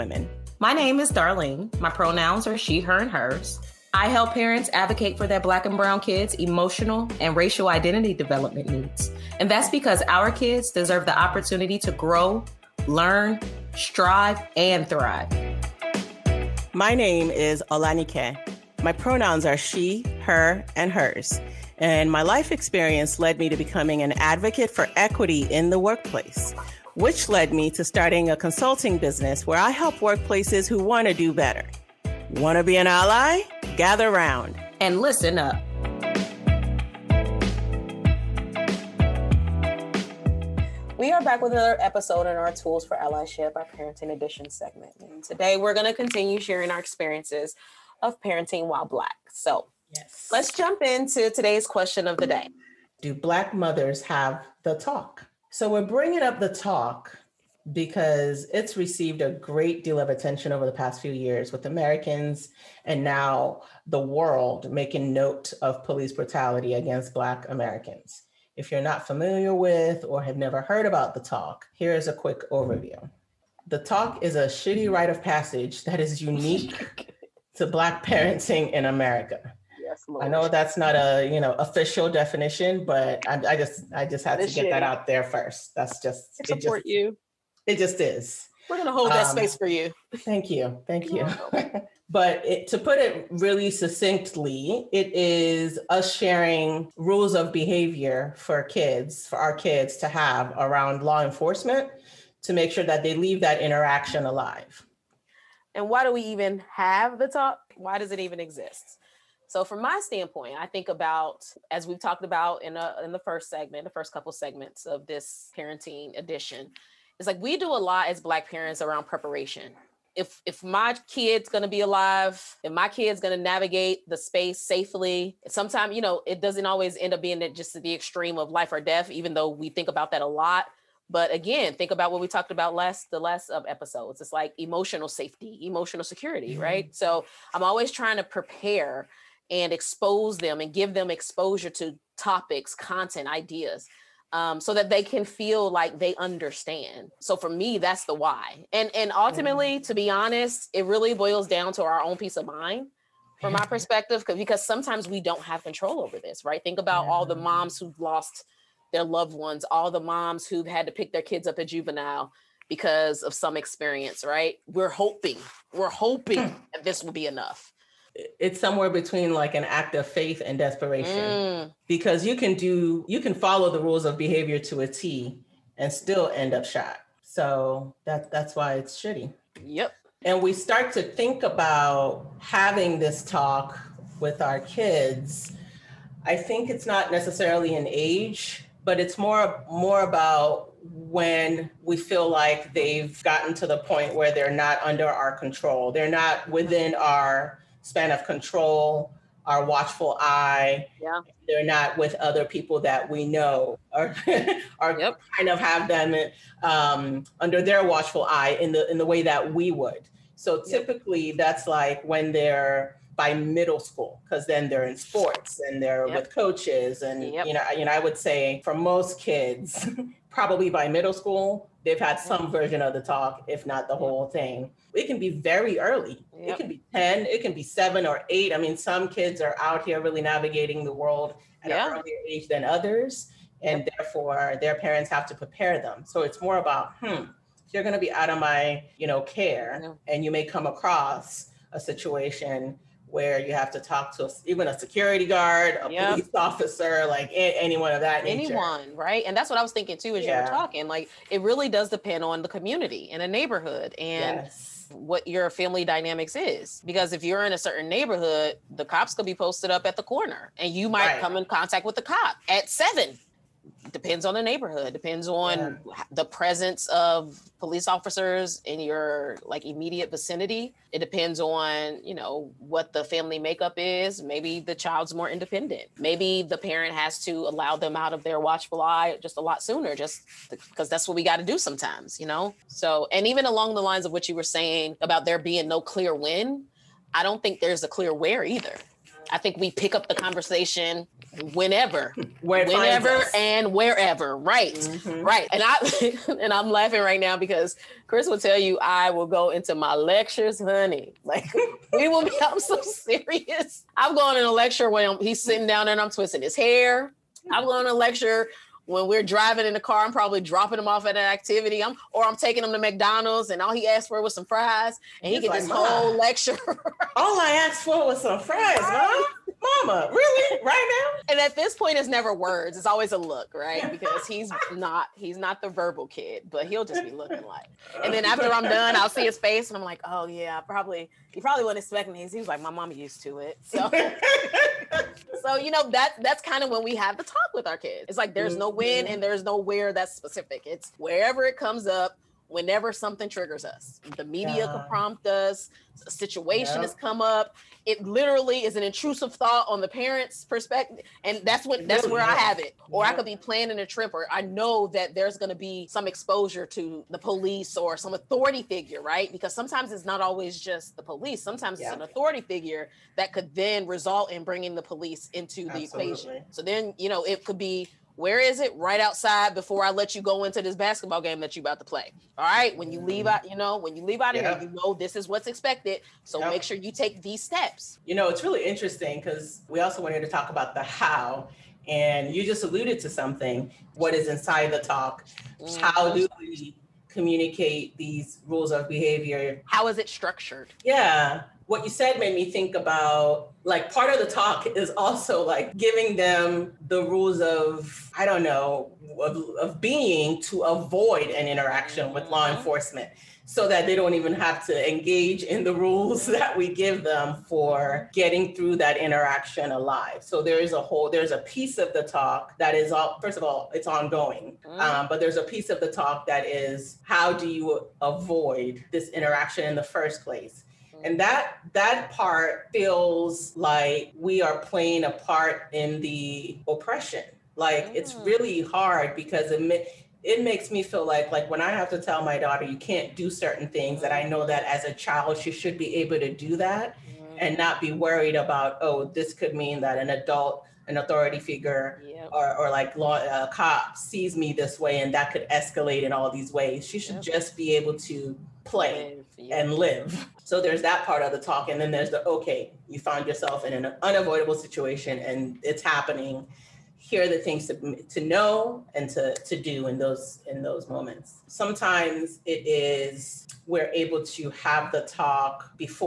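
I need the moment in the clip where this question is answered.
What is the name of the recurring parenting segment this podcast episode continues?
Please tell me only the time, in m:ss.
0:42.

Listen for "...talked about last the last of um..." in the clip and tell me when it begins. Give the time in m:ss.
2:12.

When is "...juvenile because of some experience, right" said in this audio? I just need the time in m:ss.
2:41.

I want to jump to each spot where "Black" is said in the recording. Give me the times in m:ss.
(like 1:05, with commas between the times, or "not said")
0:05, 0:48, 0:53, 1:07, 1:17, 1:58.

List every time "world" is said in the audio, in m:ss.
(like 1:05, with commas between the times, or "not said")
1:03, 3:50.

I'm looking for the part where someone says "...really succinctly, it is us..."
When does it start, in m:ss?
1:33.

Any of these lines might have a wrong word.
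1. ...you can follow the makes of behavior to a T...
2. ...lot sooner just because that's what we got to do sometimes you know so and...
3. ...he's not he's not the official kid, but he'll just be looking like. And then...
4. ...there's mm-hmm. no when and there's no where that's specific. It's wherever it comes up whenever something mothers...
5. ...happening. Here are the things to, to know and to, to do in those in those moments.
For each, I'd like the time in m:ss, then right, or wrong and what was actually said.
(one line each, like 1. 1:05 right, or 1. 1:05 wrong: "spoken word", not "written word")
1. 2:53 wrong: "rules", not "makes"
2. 4:39 right
3. 5:24 wrong: "verbal", not "official"
4. 5:38 wrong: "triggers", not "mothers"
5. 7:35 right.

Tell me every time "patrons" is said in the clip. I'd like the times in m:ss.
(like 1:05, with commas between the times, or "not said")
not said.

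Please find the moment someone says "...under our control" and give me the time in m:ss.
3:14.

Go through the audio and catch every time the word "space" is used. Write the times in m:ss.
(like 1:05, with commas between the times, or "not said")
1:29, 2:04.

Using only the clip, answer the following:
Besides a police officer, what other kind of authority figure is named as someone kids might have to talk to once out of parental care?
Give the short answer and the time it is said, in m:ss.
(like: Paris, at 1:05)
security guard, at 4:04.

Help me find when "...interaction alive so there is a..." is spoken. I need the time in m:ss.
6:48.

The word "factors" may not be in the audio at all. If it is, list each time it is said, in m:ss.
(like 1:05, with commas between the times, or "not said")
not said.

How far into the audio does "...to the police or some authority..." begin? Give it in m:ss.
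5:56.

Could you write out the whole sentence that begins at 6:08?
Right outside before I let you go into this basketball game that you are about to play.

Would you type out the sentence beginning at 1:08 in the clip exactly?
If you're not familiar with or have never heard about the talk, here is a quick overview.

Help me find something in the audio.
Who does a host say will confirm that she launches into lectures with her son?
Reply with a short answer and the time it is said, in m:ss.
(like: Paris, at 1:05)
Chris, at 4:58.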